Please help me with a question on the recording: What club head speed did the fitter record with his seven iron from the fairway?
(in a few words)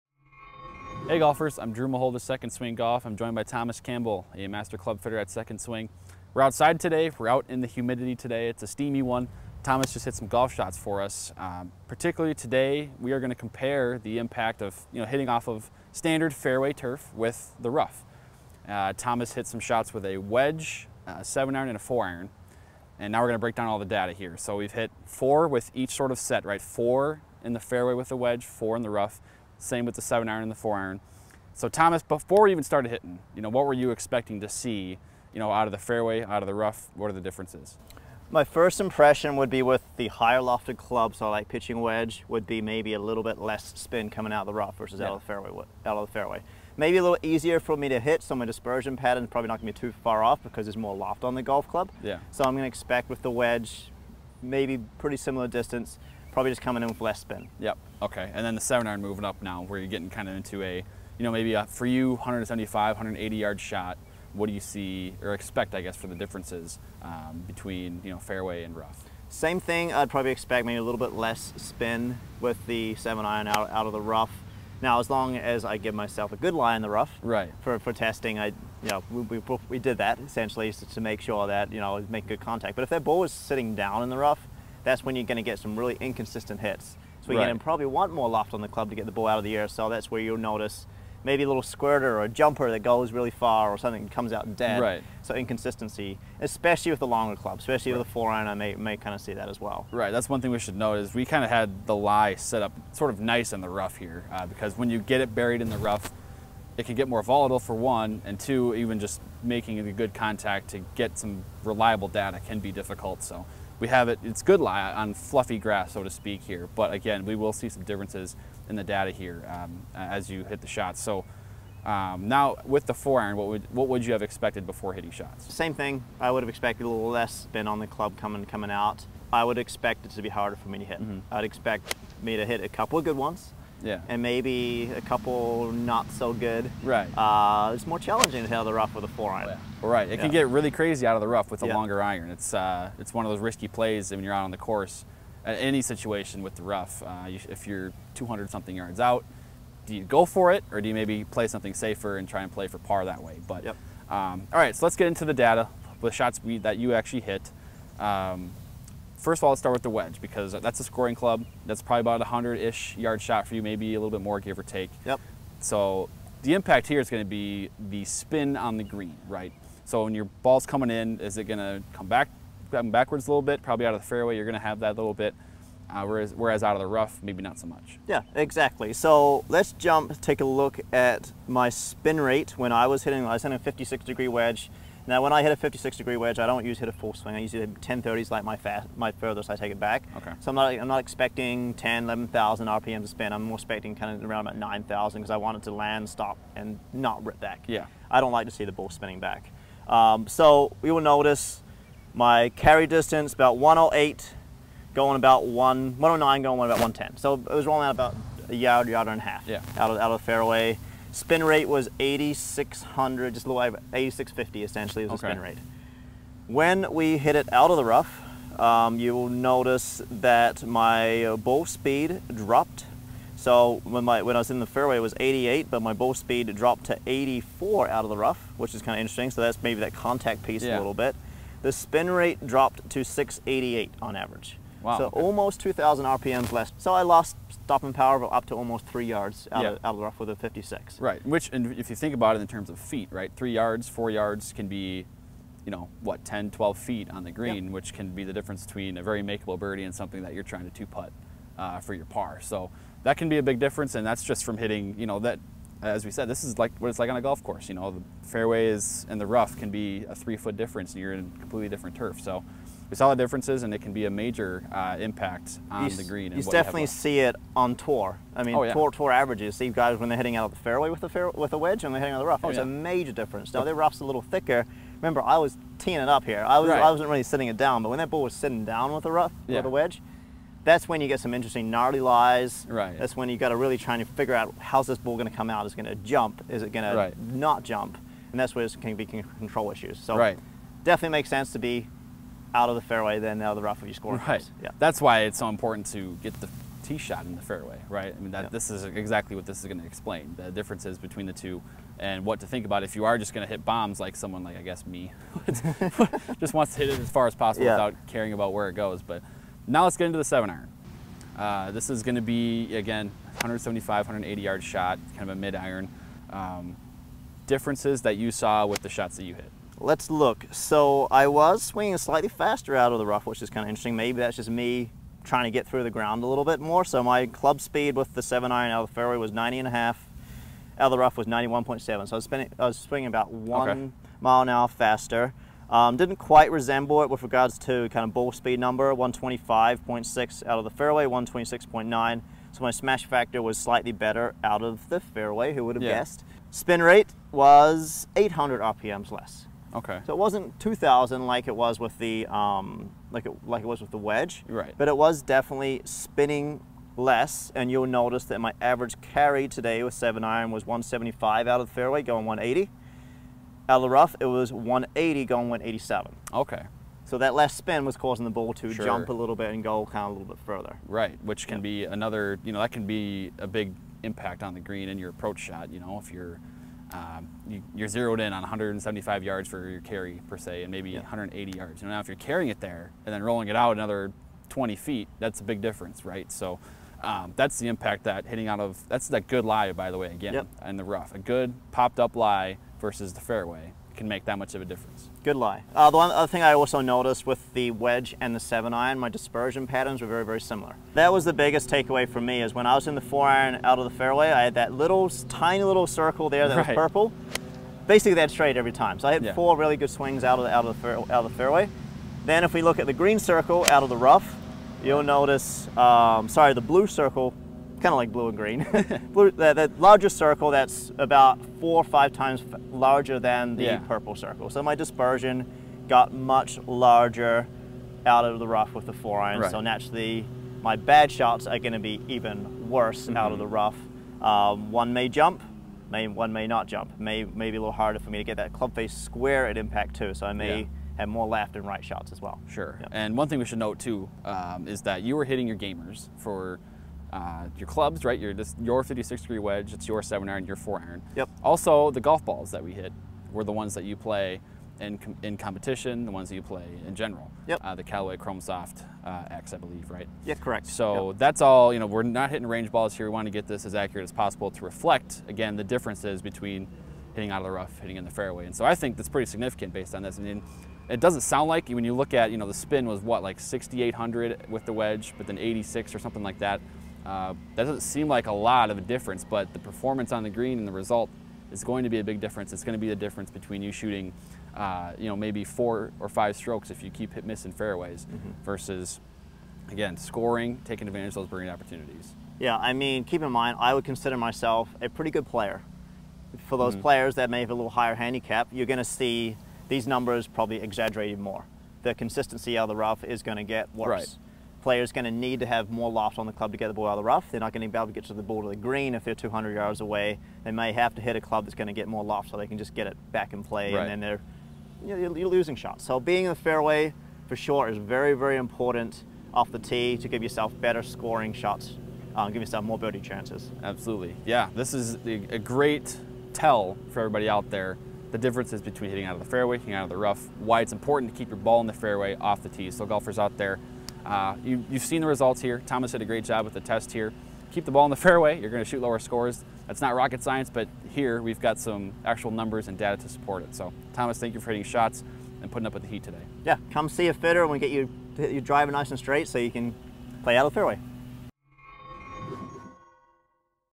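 90.5.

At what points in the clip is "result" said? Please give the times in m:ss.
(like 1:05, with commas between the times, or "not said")
8:00, 8:55.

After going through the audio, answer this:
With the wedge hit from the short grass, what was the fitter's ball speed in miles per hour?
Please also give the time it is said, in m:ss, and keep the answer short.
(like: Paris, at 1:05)
88, at 3:44.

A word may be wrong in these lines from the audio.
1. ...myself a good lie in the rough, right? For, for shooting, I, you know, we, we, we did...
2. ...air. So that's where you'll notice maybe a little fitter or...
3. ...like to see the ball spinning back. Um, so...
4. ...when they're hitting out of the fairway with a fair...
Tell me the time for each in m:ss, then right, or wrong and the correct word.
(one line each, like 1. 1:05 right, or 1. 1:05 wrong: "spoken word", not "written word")
1. 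1:15 wrong: "testing", not "shooting"
2. 1:29 wrong: "squirter", not "fitter"
3. 3:18 right
4. 4:29 right.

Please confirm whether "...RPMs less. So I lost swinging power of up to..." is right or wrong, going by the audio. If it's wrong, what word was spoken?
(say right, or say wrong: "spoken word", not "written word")
wrong: "stopping", not "swinging".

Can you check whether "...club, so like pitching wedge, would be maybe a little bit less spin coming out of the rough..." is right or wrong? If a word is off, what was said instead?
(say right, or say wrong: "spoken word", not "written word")
right.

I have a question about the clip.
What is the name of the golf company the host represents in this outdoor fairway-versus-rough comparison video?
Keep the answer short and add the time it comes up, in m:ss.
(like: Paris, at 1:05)
Second Swing Golf, at 0:02.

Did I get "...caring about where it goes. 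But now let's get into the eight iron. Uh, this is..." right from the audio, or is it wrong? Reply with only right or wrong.
wrong.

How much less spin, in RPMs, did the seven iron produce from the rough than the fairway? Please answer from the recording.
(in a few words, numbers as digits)
800.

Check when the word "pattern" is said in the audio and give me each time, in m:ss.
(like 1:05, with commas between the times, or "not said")
0:48, 6:39.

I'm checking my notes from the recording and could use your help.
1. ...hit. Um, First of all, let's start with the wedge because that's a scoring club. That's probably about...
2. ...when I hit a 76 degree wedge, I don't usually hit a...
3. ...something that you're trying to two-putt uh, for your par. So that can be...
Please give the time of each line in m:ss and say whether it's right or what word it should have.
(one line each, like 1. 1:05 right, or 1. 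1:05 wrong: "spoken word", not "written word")
1. 2:37 right
2. 3:05 wrong: "56", not "76"
3. 4:09 right.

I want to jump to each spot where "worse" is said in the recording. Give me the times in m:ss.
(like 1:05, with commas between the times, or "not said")
7:12, 8:23.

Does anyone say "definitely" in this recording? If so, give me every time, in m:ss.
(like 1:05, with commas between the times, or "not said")
4:26, 4:50, 5:55.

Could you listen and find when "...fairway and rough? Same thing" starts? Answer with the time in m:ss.
1:08.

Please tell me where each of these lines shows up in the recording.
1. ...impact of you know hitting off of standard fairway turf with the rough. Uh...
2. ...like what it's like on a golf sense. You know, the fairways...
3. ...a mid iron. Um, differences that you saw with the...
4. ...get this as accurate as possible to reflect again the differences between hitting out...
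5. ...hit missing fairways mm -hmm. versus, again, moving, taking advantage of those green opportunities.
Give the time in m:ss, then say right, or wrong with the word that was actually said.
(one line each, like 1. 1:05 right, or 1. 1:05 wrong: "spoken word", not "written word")
1. 0:14 right
2. 4:16 wrong: "course", not "sense"
3. 5:15 right
4. 7:43 right
5. 8:07 wrong: "scoring", not "moving".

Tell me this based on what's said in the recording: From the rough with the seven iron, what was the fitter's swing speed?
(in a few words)
91.7.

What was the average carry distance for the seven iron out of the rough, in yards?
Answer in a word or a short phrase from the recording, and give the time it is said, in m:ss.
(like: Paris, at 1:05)
180, at 6:04.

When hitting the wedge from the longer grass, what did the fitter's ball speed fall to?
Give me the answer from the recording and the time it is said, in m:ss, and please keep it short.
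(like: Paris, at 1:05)
84, at 3:46.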